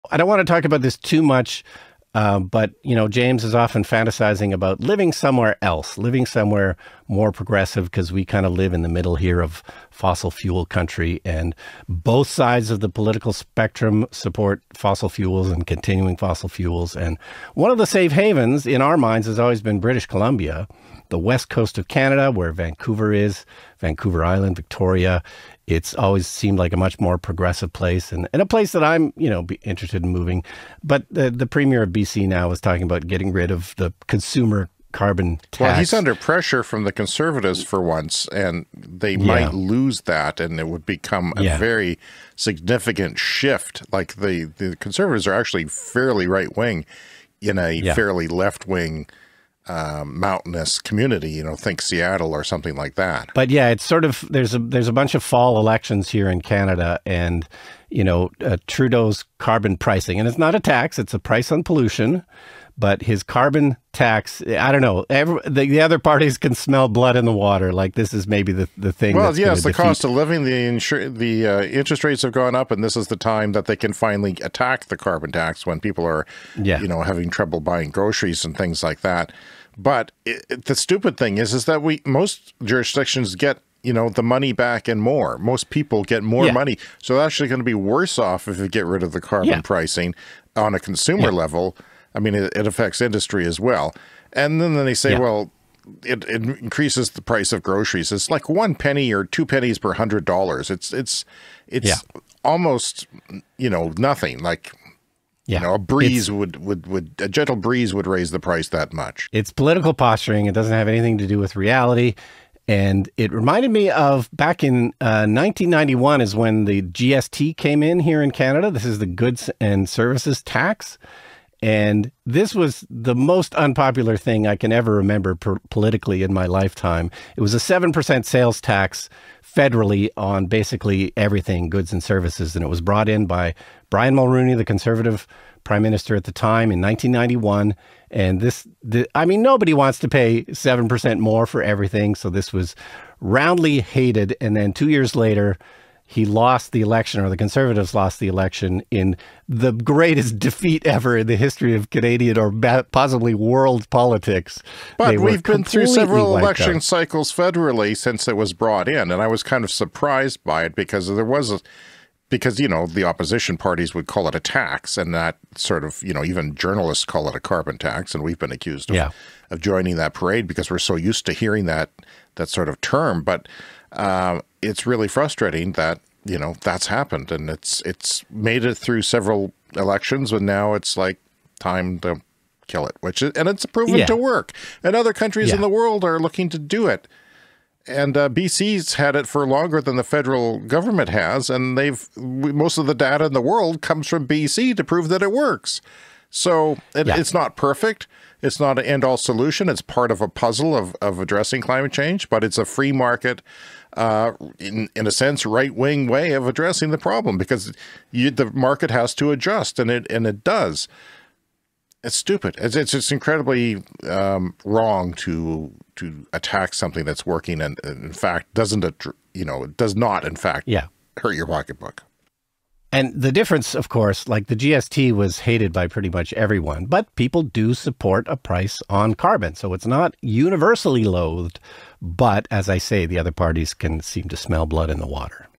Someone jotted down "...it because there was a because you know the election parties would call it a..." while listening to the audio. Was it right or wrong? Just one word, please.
wrong.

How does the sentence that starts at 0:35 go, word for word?
Well, he's under pressure from the conservatives for once, and they yeah.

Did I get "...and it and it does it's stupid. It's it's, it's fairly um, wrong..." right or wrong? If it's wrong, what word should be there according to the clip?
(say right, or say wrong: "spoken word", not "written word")
wrong: "incredibly", not "fairly".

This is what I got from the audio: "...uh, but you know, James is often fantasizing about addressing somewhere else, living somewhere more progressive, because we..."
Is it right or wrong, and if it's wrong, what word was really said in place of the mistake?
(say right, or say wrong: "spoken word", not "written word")
wrong: "living", not "addressing".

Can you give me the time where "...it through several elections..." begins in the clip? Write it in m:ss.
2:58.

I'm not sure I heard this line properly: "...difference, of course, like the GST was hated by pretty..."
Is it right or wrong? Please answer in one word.
right.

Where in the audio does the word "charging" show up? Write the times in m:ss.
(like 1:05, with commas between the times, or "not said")
not said.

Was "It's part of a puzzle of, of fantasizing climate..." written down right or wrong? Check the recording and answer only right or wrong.
wrong.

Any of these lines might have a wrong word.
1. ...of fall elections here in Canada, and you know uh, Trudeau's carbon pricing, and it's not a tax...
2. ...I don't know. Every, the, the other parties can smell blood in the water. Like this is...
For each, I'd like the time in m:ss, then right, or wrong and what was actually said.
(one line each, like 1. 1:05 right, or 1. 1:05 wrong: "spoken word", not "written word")
1. 0:55 right
2. 1:04 right.